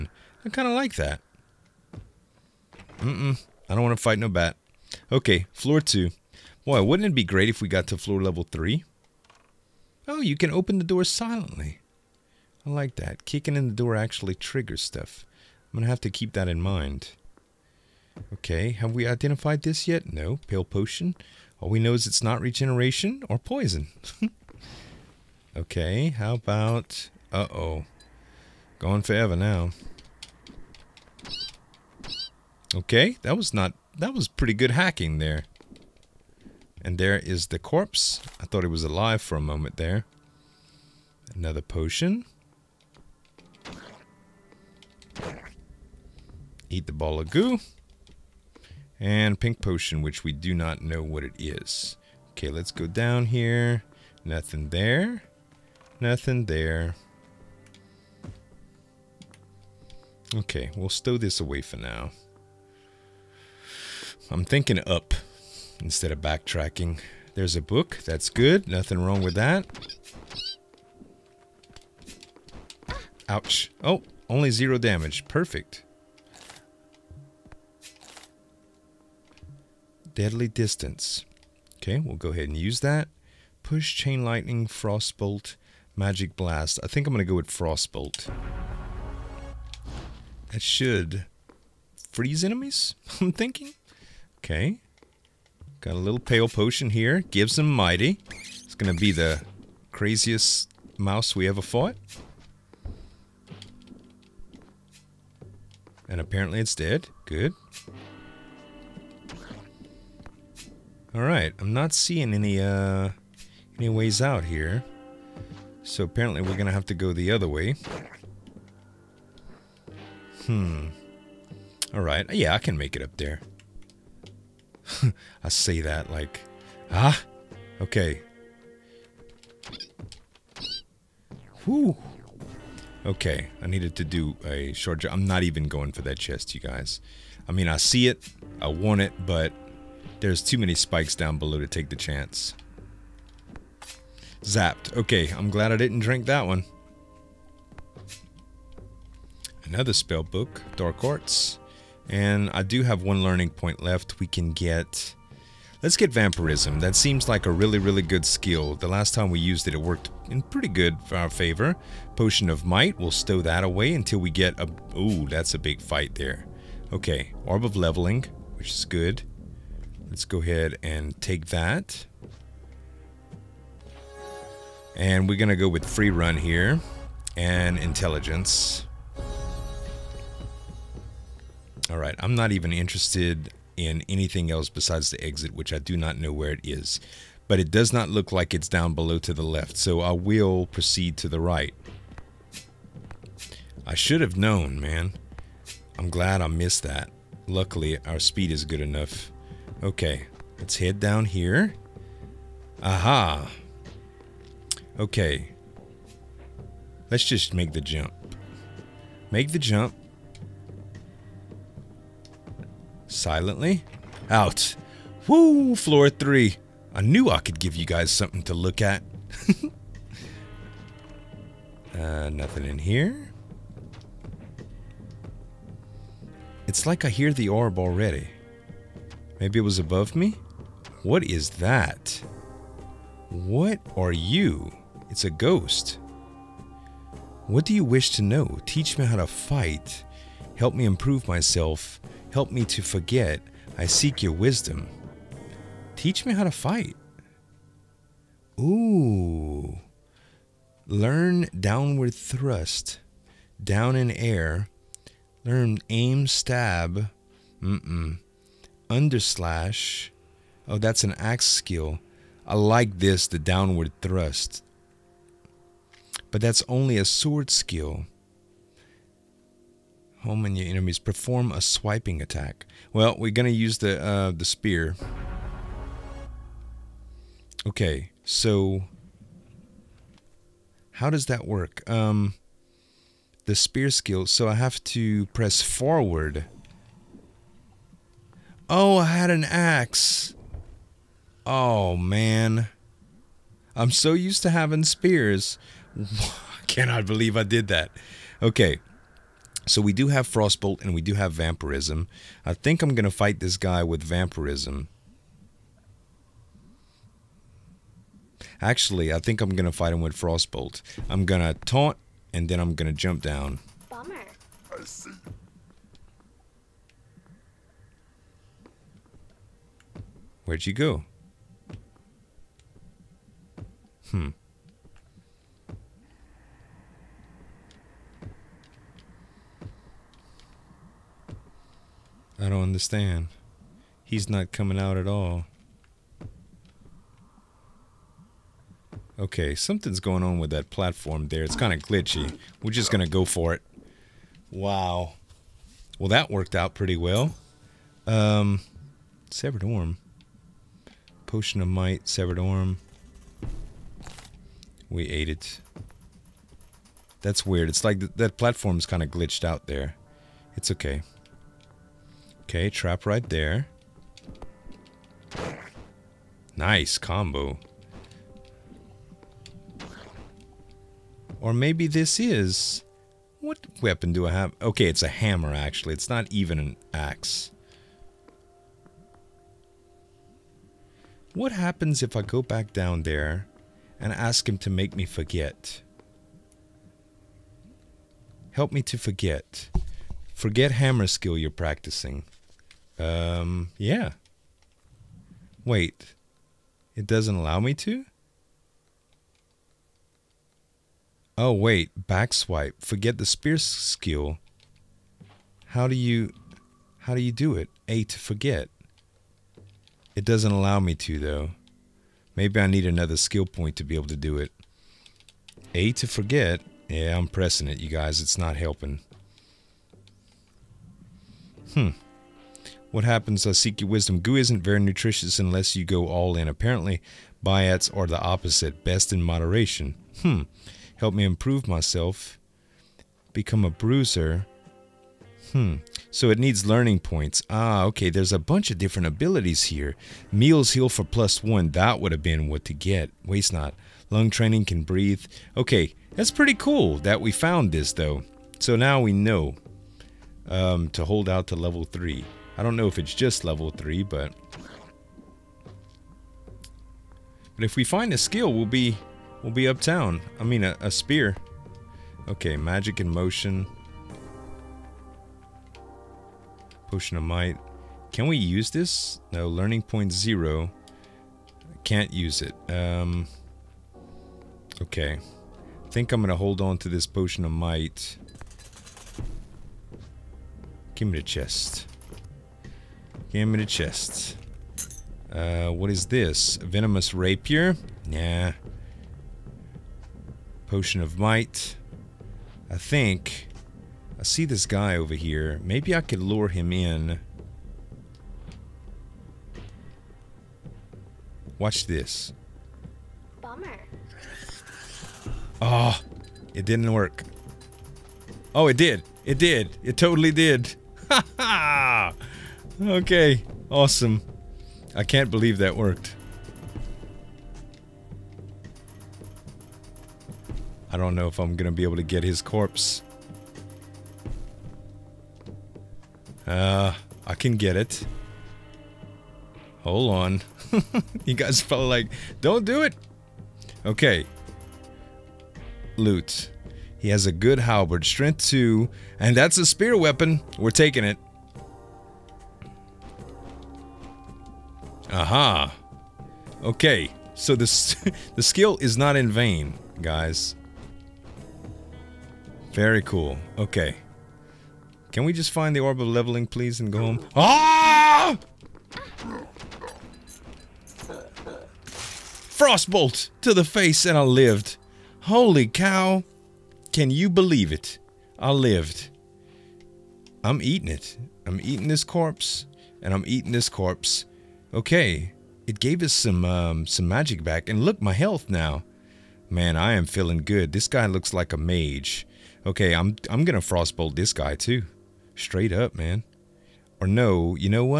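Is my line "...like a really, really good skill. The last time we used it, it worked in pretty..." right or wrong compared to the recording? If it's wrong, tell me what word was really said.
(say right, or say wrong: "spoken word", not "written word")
right.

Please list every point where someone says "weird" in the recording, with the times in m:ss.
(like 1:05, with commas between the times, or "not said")
5:57.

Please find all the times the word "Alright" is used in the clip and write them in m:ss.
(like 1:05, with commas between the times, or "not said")
1:51, 2:01.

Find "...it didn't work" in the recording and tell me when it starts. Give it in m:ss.
8:26.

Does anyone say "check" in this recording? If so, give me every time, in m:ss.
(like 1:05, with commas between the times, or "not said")
not said.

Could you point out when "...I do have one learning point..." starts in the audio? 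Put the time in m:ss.
2:32.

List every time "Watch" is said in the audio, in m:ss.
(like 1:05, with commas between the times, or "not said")
8:21.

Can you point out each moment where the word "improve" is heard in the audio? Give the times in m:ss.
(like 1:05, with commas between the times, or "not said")
4:00, 7:11.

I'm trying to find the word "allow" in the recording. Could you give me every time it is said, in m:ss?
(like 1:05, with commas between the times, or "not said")
6:37, 6:50.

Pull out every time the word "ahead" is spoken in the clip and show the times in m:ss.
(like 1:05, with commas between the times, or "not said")
1:22, 2:50.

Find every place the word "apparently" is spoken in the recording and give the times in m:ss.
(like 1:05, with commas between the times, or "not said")
1:46, 1:56, 7:06.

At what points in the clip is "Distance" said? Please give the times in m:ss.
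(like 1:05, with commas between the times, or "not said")
1:20.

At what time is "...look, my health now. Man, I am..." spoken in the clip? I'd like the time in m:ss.
9:37.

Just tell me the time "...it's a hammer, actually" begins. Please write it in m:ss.
6:14.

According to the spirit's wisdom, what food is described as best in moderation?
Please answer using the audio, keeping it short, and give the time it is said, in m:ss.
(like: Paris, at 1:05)
Biats, at 7:07.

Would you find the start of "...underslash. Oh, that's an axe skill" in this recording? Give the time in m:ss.
4:18.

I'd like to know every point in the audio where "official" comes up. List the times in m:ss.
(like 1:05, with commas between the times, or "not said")
not said.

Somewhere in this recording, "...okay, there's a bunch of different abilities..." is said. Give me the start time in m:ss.
7:17.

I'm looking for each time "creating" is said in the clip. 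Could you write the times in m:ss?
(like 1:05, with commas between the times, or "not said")
not said.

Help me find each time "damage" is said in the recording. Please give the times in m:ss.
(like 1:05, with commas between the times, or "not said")
1:14.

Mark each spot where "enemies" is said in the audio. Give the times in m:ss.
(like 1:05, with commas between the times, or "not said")
1:32, 4:30.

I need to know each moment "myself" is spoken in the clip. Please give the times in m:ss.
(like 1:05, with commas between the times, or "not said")
4:01, 7:11.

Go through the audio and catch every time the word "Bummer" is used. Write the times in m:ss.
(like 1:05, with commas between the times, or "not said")
5:13, 8:23.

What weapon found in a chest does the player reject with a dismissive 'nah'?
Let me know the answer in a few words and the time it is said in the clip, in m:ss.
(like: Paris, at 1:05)
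Venomous Rapier, at 8:06.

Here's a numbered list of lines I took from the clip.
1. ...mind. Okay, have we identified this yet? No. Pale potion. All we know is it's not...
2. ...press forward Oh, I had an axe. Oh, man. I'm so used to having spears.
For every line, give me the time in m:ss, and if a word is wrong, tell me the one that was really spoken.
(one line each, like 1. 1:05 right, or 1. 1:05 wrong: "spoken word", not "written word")
1. 0:16 right
2. 4:45 right.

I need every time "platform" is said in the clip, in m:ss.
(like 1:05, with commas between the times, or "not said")
5:40, 5:58.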